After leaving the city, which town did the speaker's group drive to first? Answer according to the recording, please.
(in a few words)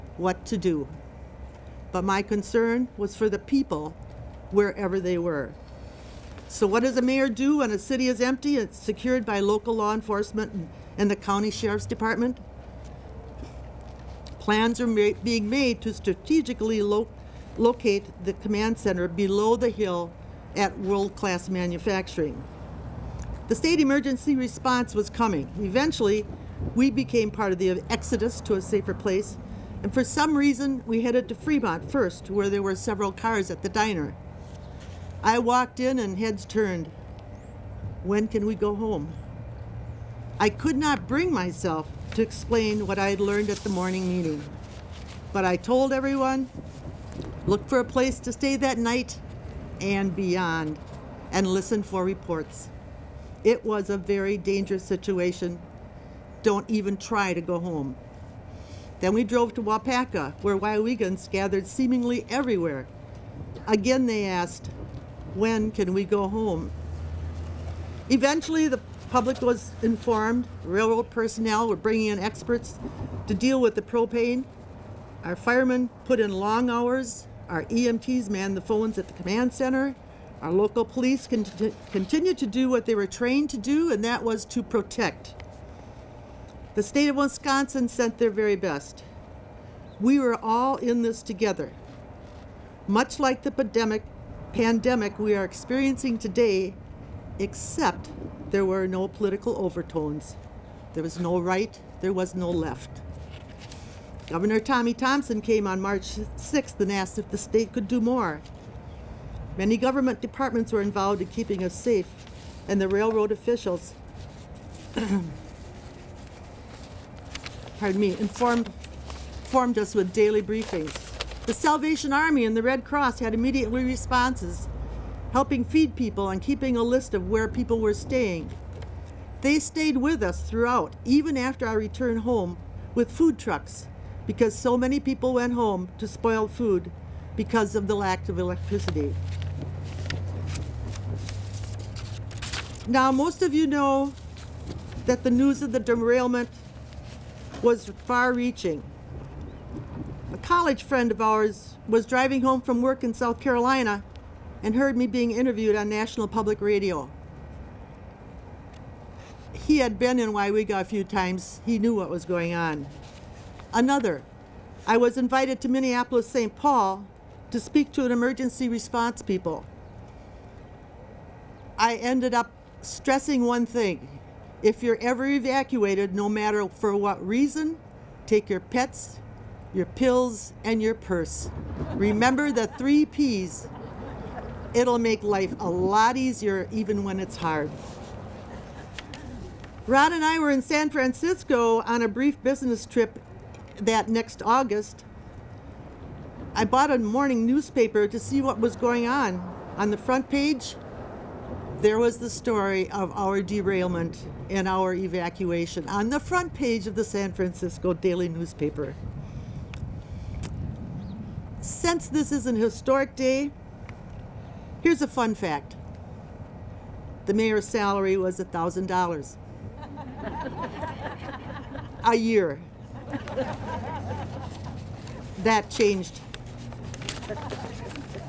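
Fremont.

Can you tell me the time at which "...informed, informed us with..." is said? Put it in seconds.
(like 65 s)
118 s.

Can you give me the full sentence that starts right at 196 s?
I bought a morning newspaper to see what was going on.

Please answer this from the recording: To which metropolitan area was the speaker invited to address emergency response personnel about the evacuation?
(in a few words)
Minneapolis St. Paul.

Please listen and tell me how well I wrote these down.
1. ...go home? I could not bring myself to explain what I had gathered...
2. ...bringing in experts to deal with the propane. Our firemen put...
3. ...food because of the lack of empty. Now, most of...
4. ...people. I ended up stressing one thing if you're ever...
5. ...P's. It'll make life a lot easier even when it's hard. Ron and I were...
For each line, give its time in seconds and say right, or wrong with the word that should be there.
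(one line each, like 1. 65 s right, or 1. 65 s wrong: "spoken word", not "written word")
1. 38 s wrong: "learned", not "gathered"
2. 71 s right
3. 136 s wrong: "electricity", not "empty"
4. 169 s right
5. 183 s right.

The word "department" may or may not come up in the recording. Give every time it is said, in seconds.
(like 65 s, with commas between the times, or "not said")
11 s, 110 s.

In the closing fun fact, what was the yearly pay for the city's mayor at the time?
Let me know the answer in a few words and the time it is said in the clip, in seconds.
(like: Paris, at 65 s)
$1,000, at 218 s.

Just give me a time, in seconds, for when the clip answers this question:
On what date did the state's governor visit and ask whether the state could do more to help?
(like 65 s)
105 s.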